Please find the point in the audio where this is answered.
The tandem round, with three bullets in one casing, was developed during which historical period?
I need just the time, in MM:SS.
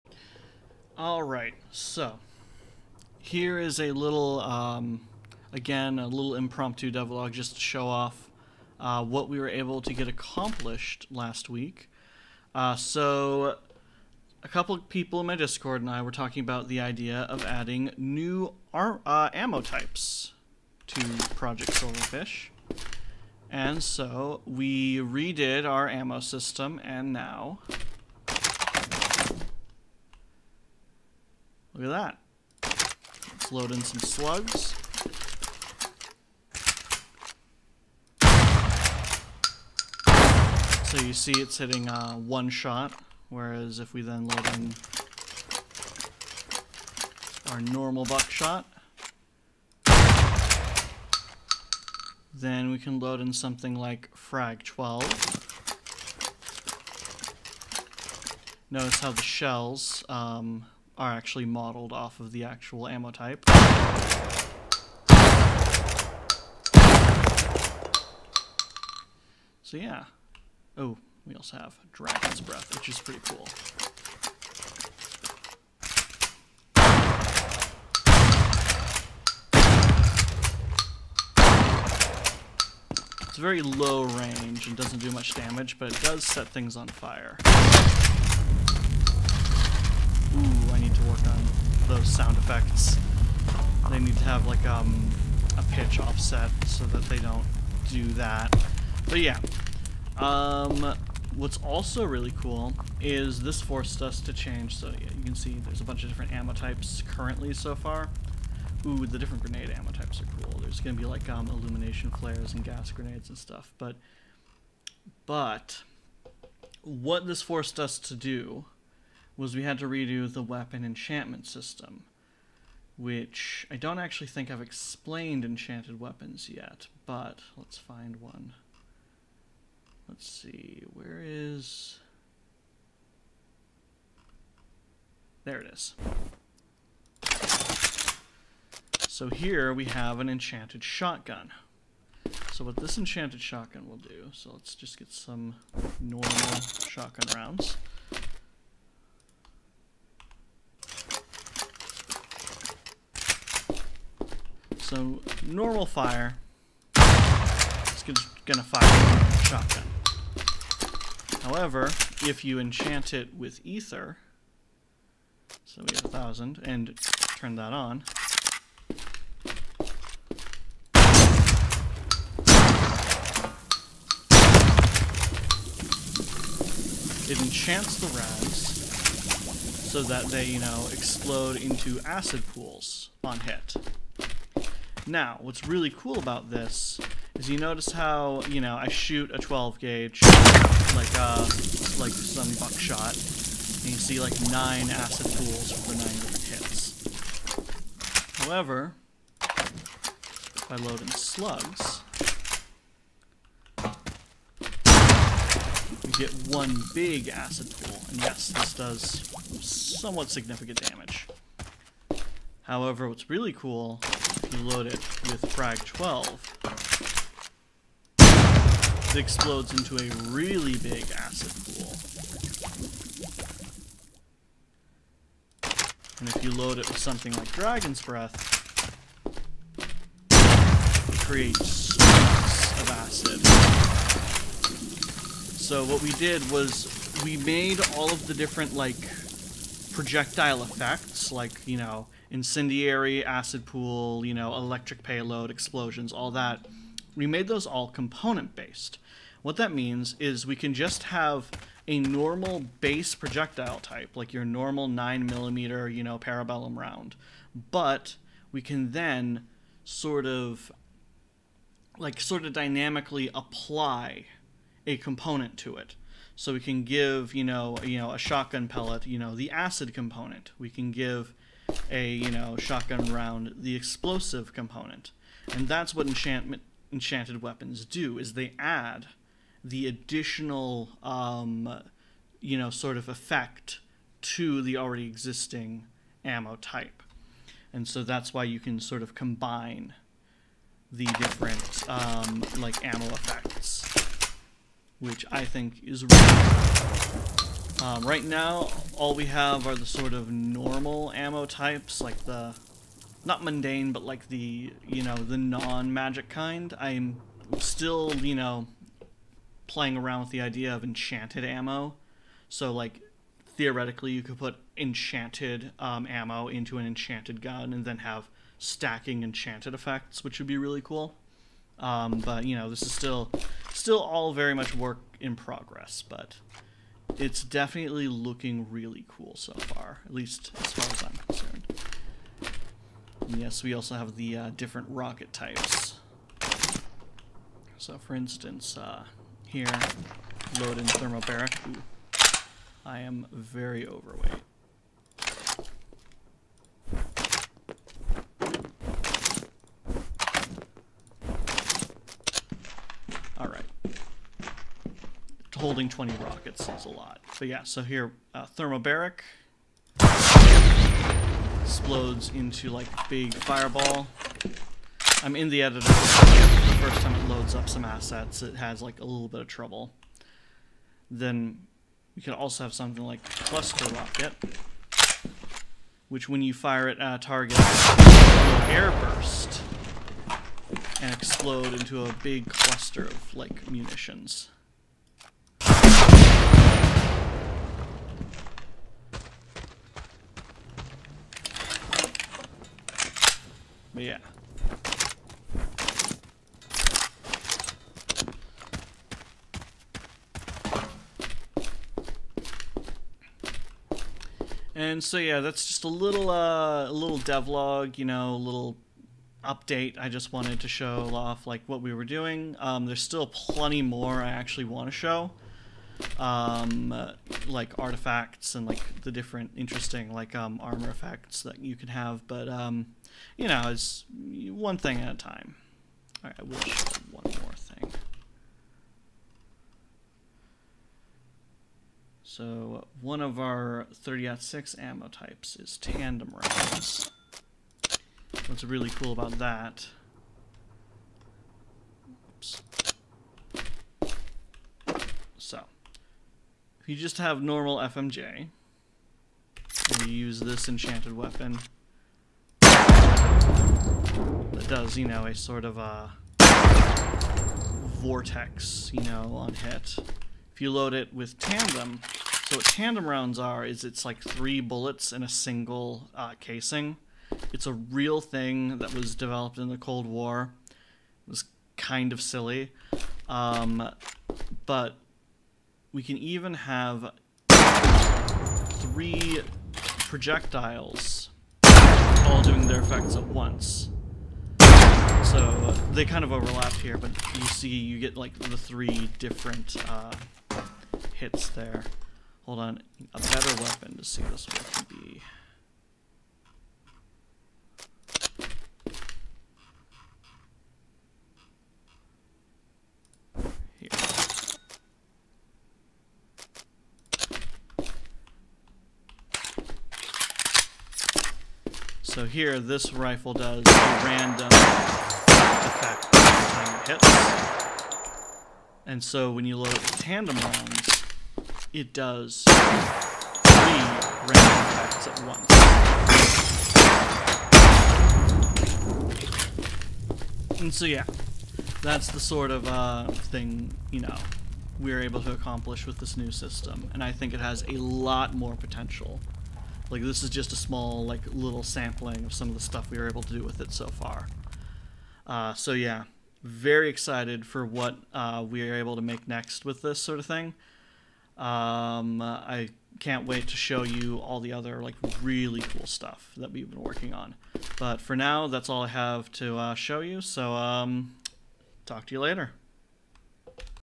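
07:49.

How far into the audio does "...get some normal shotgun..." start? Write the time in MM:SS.
02:24.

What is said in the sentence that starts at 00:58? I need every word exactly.
Notice how the shells um, are actually modeled off of the actual ammo type.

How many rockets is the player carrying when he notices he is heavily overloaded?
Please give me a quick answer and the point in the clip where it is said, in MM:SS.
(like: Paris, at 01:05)
20, at 05:55.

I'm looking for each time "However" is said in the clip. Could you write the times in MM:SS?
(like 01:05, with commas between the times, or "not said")
02:41, 03:18, 03:32.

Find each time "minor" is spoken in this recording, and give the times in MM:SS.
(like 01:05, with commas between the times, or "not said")
not said.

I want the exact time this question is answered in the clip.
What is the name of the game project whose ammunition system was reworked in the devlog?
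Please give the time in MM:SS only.
00:21.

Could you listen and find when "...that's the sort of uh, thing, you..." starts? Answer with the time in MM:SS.
08:51.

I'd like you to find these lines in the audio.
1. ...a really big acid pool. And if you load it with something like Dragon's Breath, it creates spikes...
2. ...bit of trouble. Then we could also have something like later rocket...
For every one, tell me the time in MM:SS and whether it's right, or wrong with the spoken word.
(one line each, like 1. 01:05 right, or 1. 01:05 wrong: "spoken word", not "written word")
1. 03:39 right
2. 06:09 wrong: "cluster", not "later".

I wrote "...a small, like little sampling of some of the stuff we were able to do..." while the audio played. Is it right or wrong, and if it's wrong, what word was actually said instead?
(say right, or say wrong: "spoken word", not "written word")
right.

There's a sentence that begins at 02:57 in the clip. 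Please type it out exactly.
It enchants the rounds so that they, you know, explode into acid pools on hit.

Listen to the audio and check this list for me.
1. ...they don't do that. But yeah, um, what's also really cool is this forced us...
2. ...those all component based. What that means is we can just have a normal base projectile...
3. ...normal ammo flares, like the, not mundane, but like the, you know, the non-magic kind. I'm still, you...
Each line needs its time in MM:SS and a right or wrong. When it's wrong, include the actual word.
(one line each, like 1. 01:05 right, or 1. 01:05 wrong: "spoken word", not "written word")
1. 01:37 right
2. 04:07 right
3. 05:00 wrong: "types", not "flares".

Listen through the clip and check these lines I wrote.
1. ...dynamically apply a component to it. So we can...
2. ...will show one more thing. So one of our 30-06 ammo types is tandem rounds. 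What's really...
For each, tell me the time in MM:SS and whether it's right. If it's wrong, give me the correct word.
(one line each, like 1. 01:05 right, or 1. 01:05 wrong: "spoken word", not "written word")
1. 04:22 right
2. 07:06 right.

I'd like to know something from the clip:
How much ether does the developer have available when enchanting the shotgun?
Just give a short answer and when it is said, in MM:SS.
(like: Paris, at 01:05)
1000, at 02:46.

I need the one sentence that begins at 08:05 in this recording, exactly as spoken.
So uh, they kind of overlap here, but you see you get like the three different uh, hits there.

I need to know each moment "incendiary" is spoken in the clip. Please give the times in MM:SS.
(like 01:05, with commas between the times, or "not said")
04:02.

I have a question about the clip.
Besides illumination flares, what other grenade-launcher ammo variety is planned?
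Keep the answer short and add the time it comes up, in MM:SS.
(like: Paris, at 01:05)
gas grenades, at 01:52.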